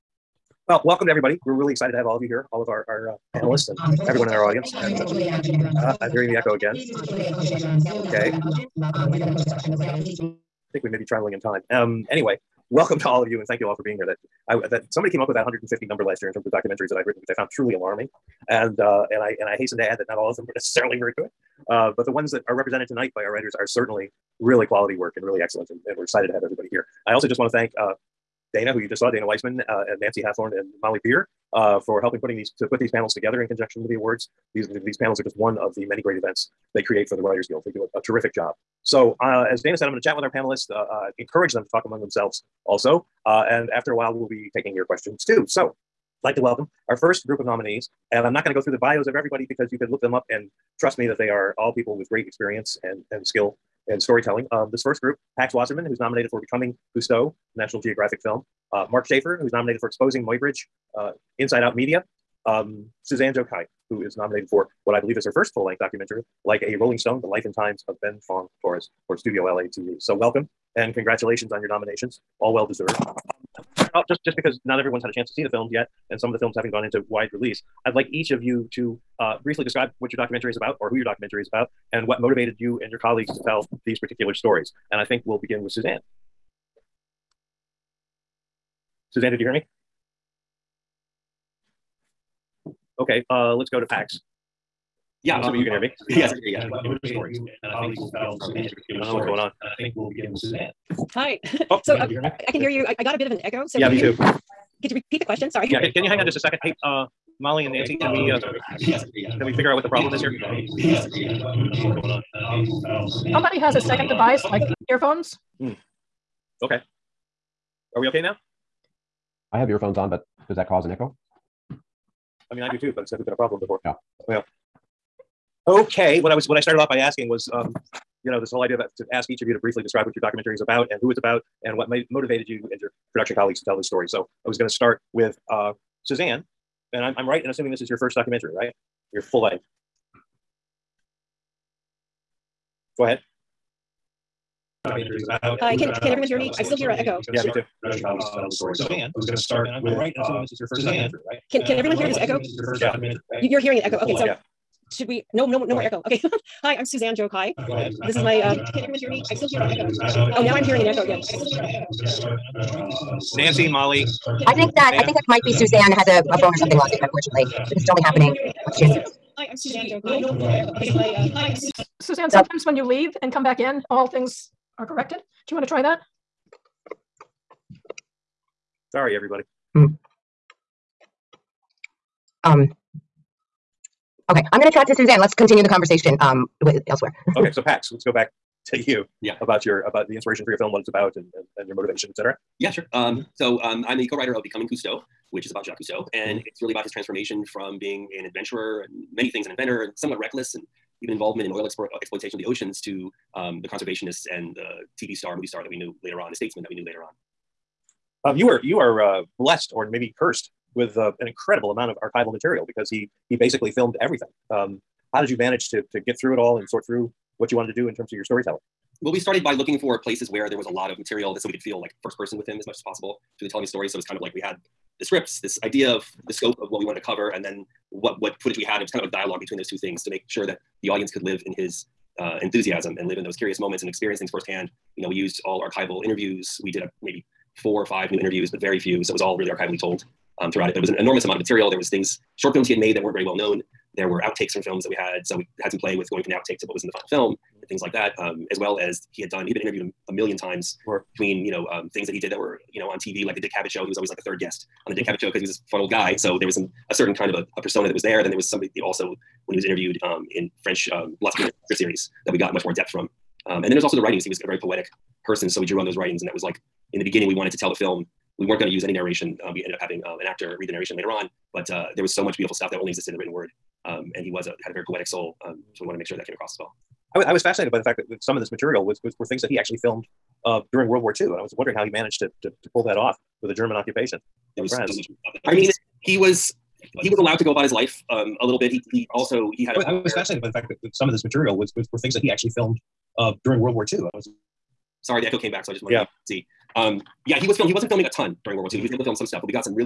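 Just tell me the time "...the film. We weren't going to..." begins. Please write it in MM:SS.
04:27.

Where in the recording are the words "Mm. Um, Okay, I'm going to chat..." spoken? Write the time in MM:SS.
02:59.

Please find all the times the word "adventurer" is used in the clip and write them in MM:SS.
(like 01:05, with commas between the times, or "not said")
03:18.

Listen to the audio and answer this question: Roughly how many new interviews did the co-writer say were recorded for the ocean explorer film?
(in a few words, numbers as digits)
4 or 5.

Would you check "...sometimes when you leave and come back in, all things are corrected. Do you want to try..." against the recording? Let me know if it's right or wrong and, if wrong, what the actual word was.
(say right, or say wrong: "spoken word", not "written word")
right.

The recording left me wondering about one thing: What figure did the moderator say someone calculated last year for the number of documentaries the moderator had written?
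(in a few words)
150.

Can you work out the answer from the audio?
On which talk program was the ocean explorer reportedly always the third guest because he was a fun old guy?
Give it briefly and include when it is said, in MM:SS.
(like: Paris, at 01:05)
The Dick Cavett Show, at 04:13.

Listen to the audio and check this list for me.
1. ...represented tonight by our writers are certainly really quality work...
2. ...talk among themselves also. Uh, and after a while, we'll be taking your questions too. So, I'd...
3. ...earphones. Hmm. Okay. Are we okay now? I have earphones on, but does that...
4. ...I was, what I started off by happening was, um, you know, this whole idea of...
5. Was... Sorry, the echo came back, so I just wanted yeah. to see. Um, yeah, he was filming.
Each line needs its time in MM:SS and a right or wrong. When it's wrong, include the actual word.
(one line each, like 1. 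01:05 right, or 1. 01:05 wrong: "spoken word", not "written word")
1. 00:22 right
2. 00:41 right
3. 01:54 right
4. 02:06 wrong: "asking", not "happening"
5. 04:54 right.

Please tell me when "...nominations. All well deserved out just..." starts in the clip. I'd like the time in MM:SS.
01:11.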